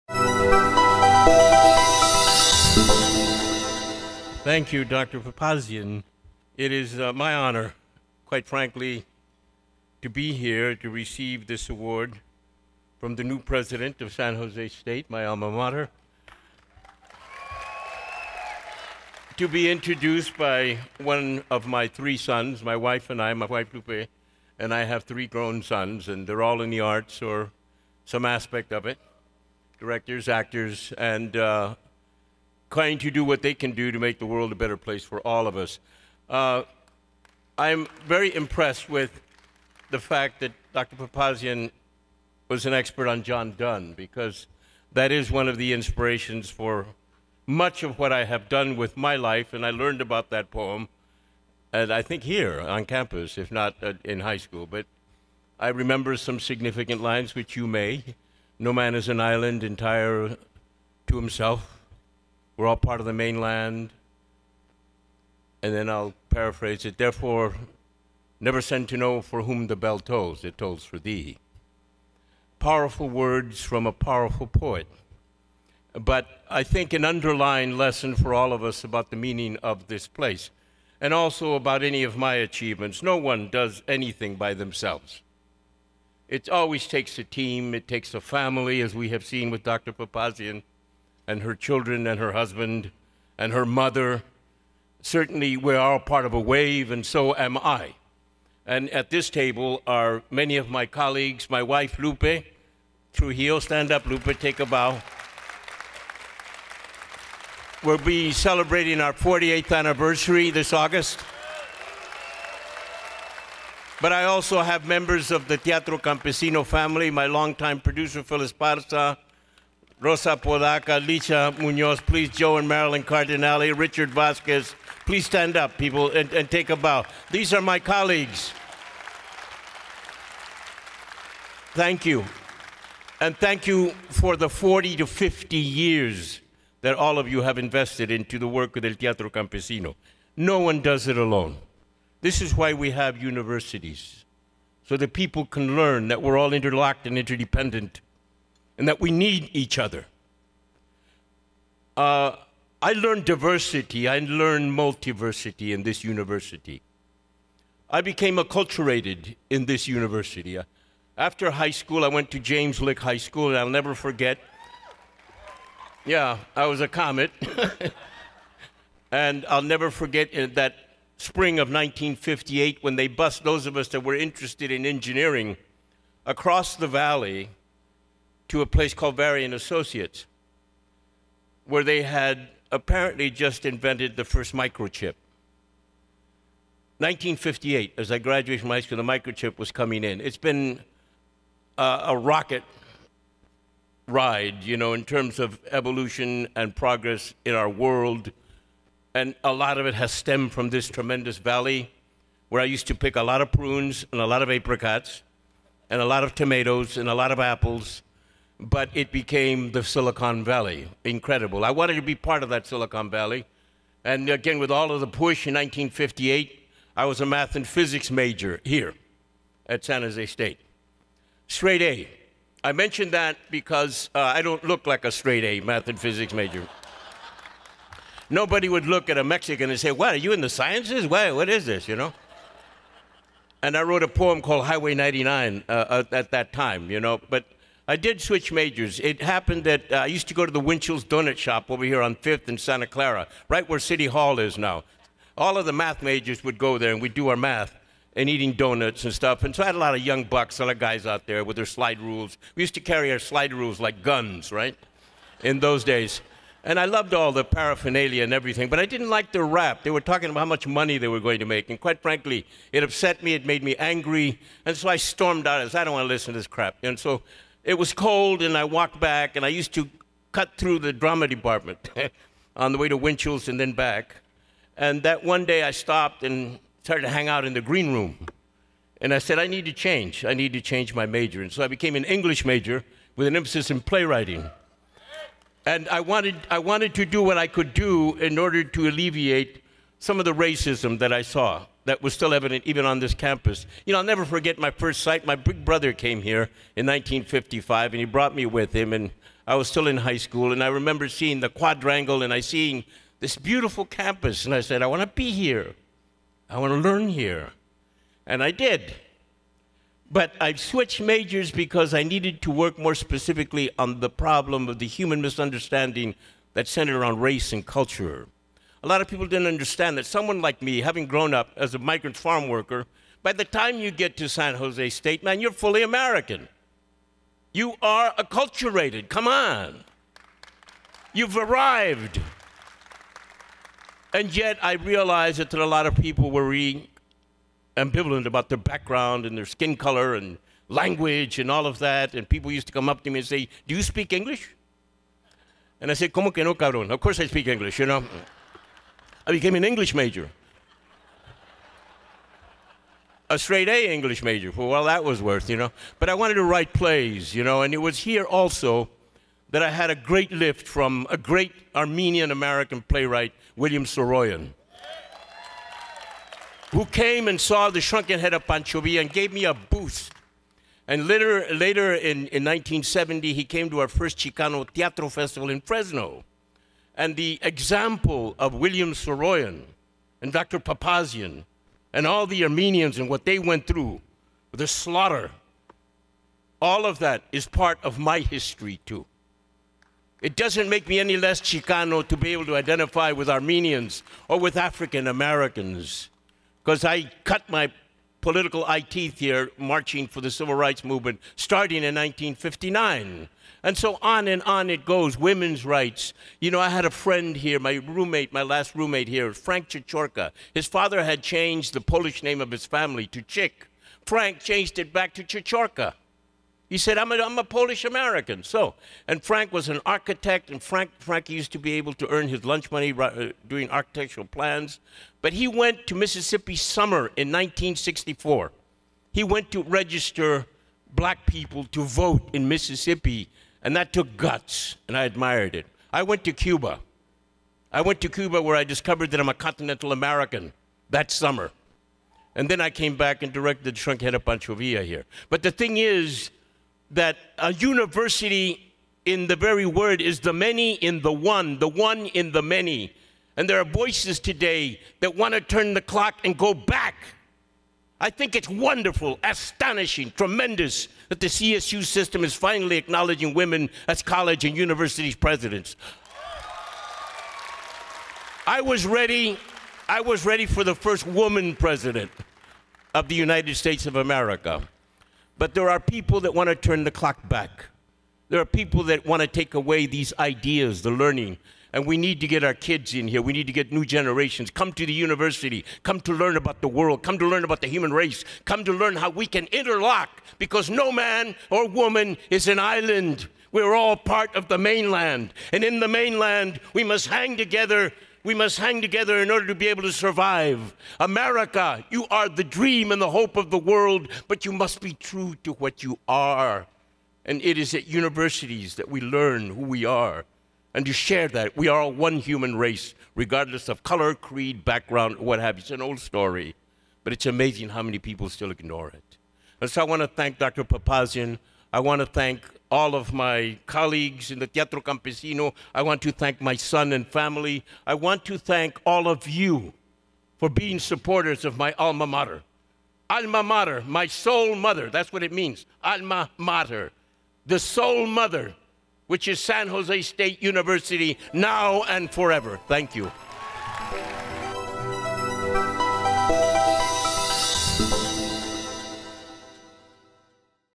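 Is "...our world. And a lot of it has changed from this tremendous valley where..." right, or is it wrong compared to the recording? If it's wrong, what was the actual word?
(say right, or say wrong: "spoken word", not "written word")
wrong: "stemmed", not "changed".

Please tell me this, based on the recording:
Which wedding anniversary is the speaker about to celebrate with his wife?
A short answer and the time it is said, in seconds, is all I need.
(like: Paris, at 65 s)
48th, at 109 s.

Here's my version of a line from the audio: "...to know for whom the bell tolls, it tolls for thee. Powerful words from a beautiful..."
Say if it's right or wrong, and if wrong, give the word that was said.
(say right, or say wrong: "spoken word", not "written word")
wrong: "powerful", not "beautiful".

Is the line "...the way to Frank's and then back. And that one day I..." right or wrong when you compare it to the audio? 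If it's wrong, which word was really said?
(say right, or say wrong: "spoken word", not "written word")
wrong: "Winchell", not "Frank".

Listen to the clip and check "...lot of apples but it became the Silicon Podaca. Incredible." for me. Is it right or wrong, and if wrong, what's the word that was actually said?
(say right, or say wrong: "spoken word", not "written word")
wrong: "Valley", not "Podaca".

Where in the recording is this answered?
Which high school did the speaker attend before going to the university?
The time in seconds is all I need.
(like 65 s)
162 s.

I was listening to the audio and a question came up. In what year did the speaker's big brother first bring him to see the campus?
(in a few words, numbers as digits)
1955.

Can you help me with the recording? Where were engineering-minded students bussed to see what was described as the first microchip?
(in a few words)
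Varian Associates.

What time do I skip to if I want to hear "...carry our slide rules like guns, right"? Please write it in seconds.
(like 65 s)
252 s.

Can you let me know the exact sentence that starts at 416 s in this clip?
He said, I'm a, I'm a Polish American.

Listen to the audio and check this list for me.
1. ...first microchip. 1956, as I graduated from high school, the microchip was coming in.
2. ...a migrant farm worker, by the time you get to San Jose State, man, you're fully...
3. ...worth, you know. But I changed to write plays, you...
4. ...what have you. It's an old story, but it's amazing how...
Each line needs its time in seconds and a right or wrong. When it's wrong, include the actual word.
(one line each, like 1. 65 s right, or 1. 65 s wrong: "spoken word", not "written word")
1. 184 s wrong: "1958", not "1956"
2. 321 s right
3. 355 s wrong: "wanted", not "changed"
4. 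515 s right.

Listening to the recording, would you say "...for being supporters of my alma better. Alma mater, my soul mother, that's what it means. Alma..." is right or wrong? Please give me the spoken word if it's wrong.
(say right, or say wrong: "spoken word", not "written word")
wrong: "mater", not "better".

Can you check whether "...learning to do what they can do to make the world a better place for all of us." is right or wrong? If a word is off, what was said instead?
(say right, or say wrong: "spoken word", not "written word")
wrong: "trying", not "learning".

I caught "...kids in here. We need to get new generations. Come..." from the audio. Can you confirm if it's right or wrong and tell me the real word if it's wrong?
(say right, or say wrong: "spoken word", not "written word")
right.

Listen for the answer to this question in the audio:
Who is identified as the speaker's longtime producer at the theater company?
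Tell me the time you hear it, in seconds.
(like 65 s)
118 s.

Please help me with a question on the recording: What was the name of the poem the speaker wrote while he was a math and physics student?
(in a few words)
Highway 99.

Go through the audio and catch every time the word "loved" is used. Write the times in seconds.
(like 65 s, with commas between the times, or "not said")
256 s.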